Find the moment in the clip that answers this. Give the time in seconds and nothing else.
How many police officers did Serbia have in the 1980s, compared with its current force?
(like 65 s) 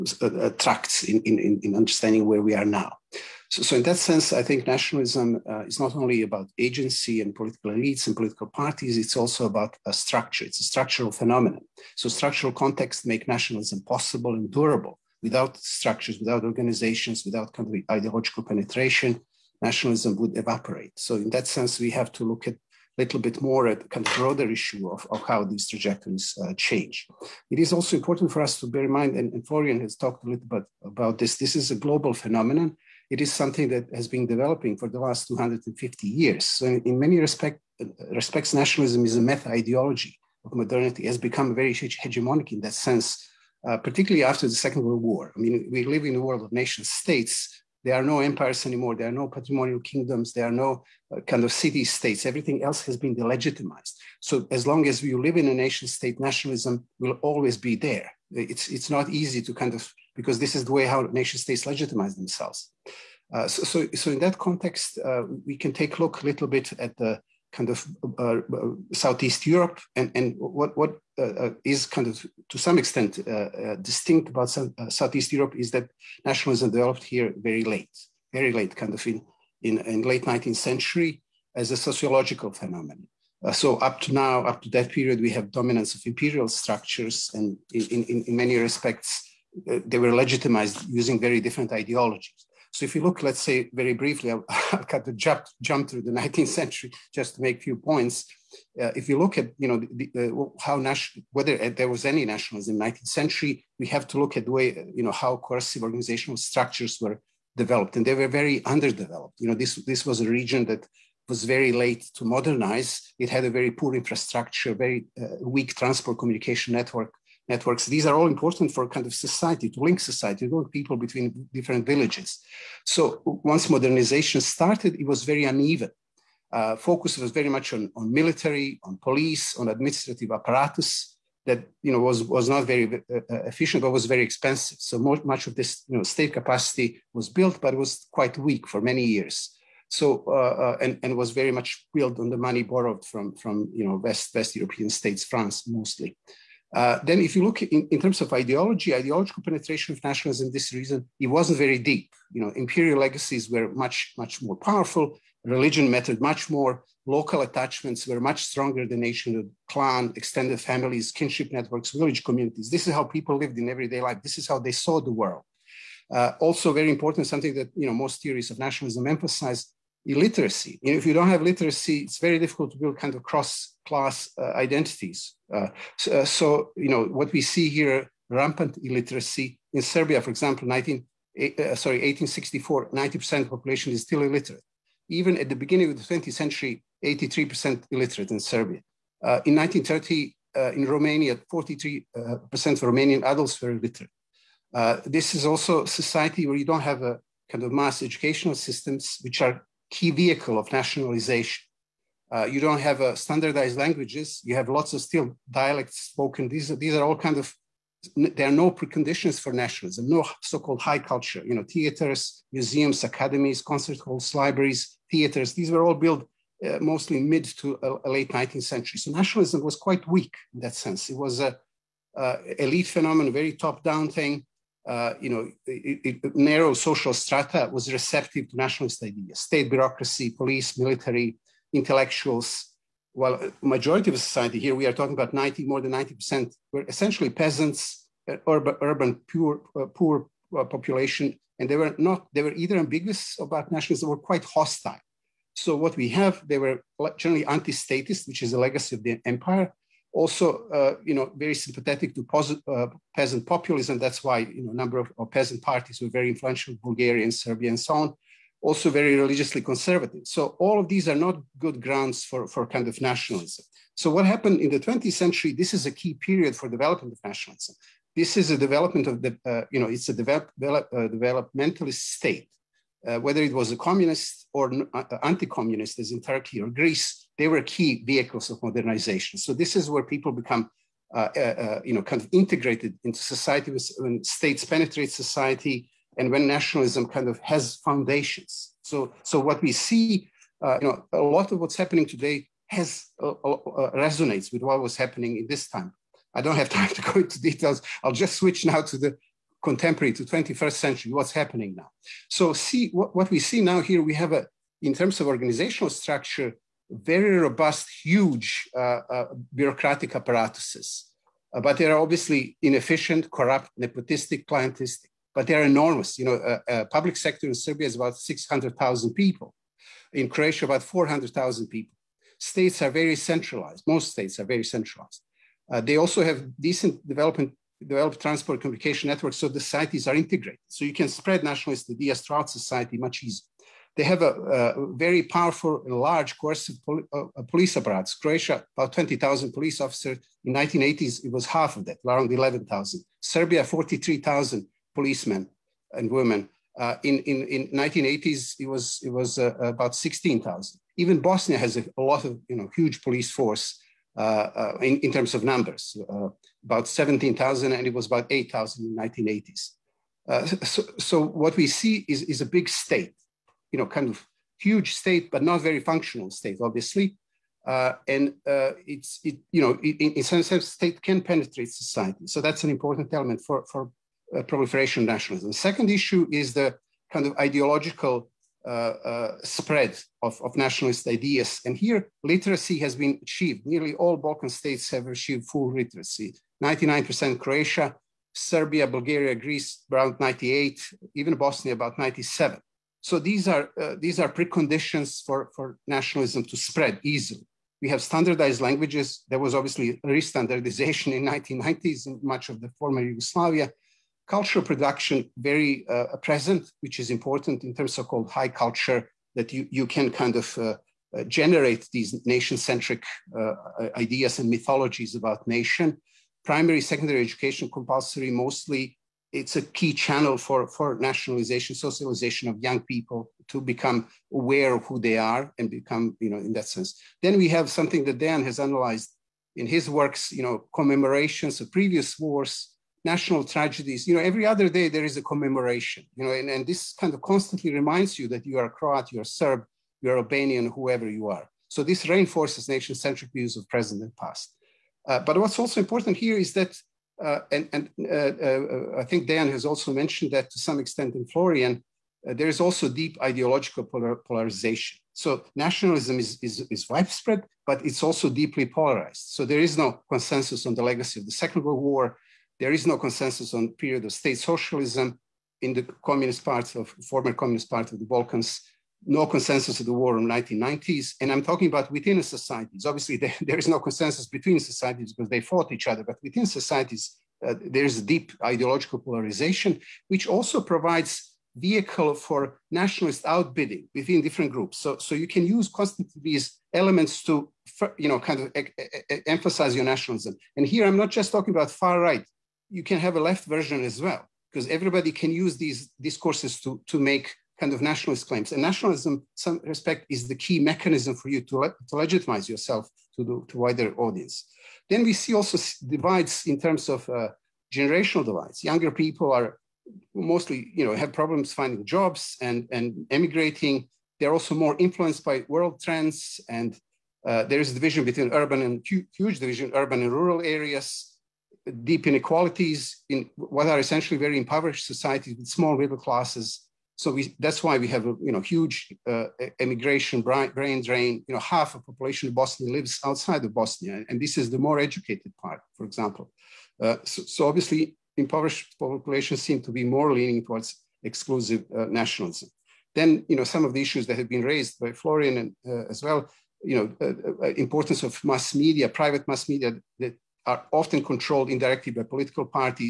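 349 s.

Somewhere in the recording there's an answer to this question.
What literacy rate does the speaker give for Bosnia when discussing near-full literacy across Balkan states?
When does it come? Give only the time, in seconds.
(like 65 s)
391 s.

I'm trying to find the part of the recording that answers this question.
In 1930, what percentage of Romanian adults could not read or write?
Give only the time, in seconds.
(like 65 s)
191 s.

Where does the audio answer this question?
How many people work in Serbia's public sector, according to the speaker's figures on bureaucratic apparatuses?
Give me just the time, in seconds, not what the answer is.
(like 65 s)
318 s.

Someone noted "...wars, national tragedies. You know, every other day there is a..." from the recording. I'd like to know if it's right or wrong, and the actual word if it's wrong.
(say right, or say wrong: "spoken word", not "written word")
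right.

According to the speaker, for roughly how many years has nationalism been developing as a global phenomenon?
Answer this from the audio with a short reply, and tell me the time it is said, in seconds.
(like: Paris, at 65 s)
250 years, at 35 s.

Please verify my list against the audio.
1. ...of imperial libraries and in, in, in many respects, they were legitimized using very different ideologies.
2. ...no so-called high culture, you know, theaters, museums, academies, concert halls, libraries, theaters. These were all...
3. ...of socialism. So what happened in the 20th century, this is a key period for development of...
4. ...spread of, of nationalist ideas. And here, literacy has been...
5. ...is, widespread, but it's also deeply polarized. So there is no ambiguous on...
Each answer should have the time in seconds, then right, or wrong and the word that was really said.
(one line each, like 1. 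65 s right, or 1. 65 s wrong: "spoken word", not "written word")
1. 85 s wrong: "structures", not "libraries"
2. 210 s right
3. 262 s wrong: "nationalism", not "socialism"
4. 379 s right
5. 456 s wrong: "consensus", not "ambiguous".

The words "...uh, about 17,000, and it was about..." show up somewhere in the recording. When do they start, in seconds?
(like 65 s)
356 s.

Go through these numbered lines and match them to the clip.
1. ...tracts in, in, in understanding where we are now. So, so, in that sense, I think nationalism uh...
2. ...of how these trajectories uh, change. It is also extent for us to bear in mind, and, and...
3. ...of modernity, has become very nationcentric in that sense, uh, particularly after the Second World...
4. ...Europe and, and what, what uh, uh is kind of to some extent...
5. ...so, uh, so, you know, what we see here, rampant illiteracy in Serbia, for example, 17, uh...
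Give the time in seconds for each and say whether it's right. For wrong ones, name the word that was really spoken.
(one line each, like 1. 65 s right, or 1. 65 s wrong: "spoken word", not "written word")
1. 0 s right
2. 25 s wrong: "important", not "extent"
3. 40 s wrong: "hegemonic", not "nationcentric"
4. 69 s right
5. 175 s wrong: "19", not "17".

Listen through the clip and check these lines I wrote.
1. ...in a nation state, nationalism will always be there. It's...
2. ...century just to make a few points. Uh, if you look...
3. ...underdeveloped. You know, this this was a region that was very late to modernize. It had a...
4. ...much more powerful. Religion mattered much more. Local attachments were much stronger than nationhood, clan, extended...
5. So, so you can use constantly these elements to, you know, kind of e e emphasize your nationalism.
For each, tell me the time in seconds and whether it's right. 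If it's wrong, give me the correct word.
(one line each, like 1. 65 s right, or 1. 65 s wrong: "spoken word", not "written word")
1. 55 s right
2. 96 s right
3. 108 s right
4. 154 s right
5. 484 s right.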